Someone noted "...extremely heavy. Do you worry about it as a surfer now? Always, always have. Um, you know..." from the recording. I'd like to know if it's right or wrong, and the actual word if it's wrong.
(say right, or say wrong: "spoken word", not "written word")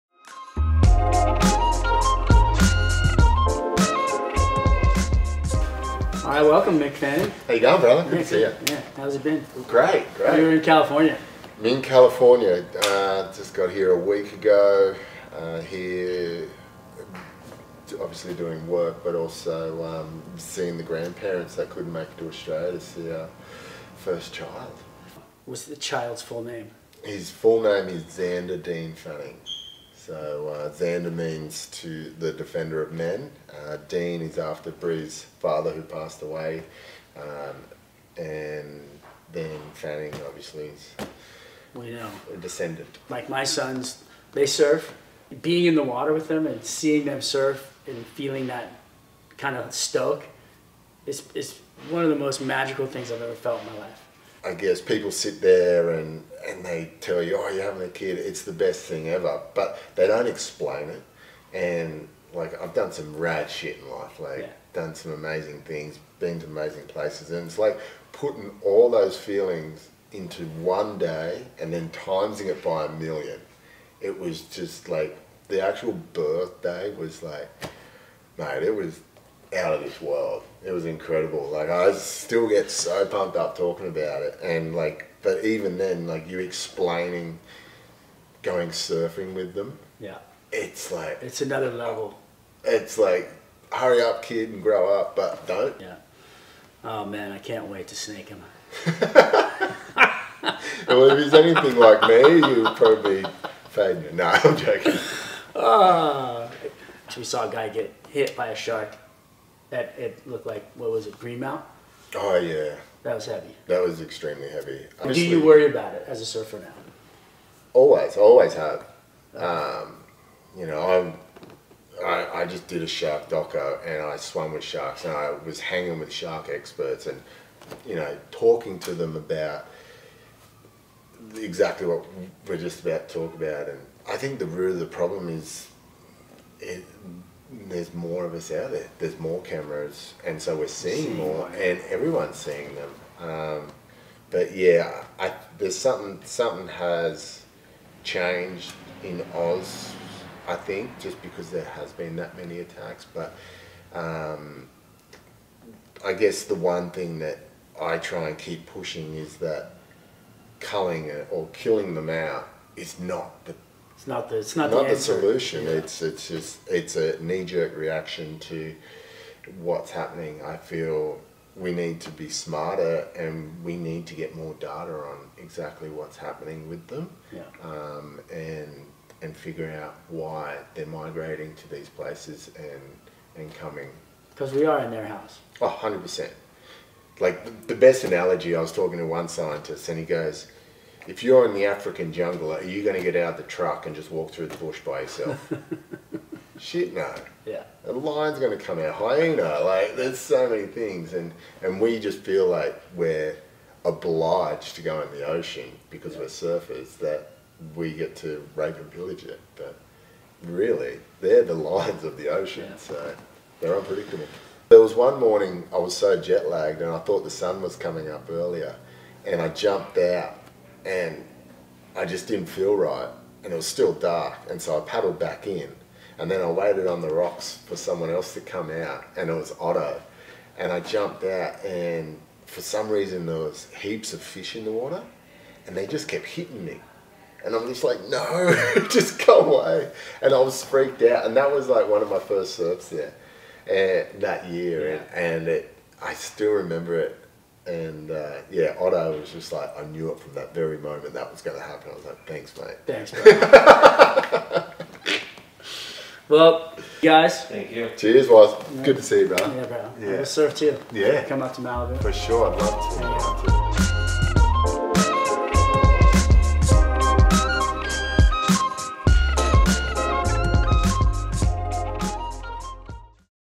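right.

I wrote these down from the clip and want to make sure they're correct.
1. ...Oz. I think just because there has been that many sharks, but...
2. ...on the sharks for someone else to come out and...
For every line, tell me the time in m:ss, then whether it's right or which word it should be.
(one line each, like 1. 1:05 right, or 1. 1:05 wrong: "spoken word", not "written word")
1. 2:29 wrong: "attacks", not "sharks"
2. 3:46 wrong: "rocks", not "sharks".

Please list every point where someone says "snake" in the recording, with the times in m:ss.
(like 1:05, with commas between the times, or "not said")
1:37.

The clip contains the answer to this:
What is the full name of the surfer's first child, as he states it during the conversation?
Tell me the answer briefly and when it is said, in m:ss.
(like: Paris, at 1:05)
Xander Dean Fanning, at 0:28.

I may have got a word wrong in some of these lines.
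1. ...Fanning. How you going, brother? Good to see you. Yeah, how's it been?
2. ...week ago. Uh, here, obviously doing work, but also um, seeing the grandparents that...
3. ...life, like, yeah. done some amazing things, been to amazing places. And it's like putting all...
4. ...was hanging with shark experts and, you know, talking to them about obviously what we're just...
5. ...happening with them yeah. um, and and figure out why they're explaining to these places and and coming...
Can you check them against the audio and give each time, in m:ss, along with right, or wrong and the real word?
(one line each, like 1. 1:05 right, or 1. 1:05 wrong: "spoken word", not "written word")
1. 0:06 right
2. 0:13 right
3. 1:03 right
4. 2:05 wrong: "exactly", not "obviously"
5. 2:56 wrong: "migrating", not "explaining".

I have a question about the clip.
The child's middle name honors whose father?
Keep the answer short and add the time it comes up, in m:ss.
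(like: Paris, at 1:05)
Bree's father, at 0:34.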